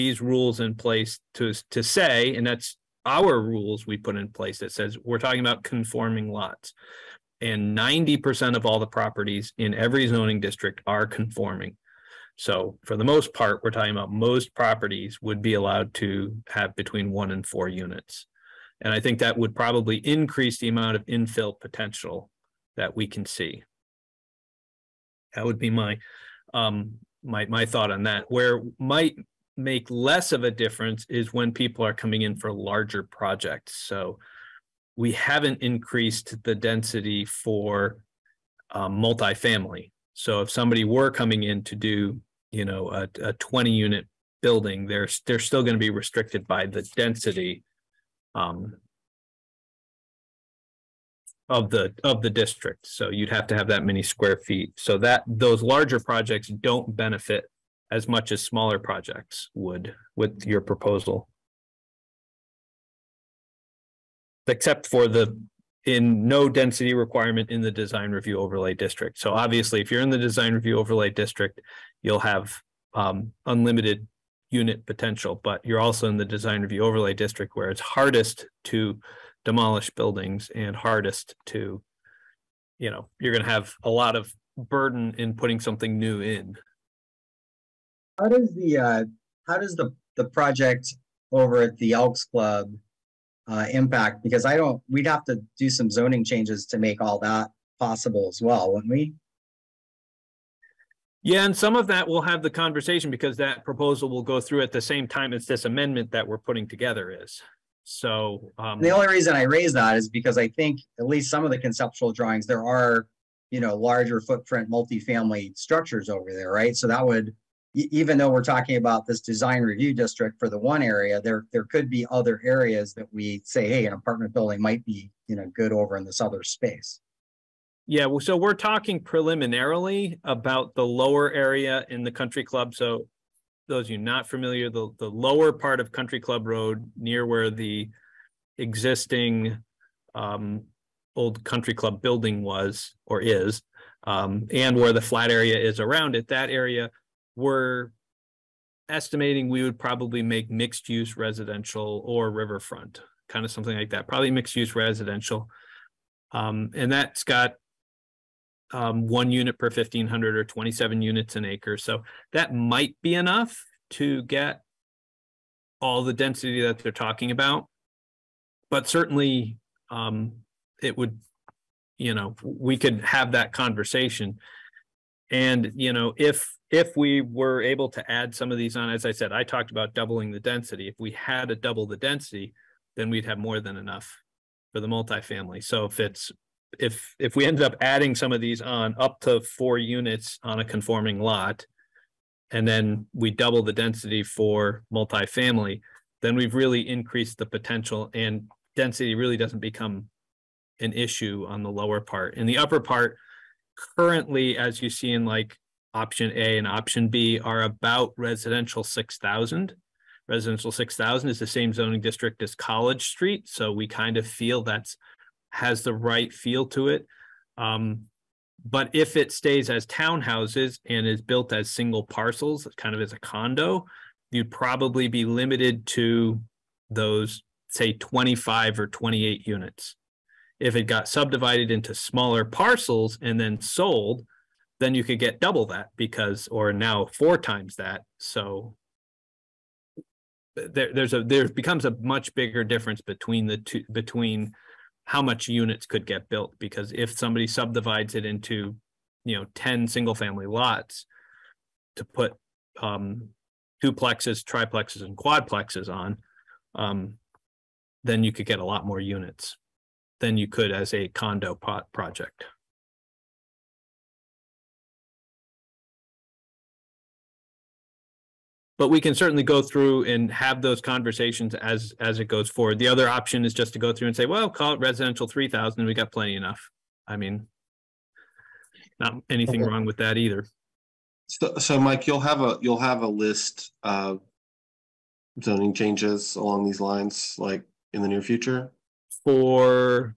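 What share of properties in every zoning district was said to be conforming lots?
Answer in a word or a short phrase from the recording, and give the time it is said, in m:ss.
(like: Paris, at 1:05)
90%, at 0:07.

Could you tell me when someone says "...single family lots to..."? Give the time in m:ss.
4:09.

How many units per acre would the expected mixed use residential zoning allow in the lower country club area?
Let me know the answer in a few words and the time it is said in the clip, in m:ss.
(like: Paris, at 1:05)
27, at 2:40.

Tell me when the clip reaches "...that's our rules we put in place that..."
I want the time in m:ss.
0:02.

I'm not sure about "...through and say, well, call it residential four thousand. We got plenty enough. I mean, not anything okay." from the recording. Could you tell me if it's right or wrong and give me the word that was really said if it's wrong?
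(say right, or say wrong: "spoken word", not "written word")
wrong: "three", not "four".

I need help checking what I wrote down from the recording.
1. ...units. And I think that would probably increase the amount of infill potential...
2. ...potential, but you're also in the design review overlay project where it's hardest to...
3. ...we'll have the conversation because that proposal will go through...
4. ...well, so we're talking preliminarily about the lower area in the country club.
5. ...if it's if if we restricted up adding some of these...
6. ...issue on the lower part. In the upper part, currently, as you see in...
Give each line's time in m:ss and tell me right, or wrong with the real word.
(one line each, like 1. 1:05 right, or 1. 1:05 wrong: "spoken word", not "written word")
1. 0:17 right
2. 1:14 wrong: "district", not "project"
3. 1:42 right
4. 2:08 right
5. 3:05 wrong: "ended", not "restricted"
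6. 3:20 right.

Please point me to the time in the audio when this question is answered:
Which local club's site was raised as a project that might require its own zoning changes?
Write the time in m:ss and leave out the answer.
1:31.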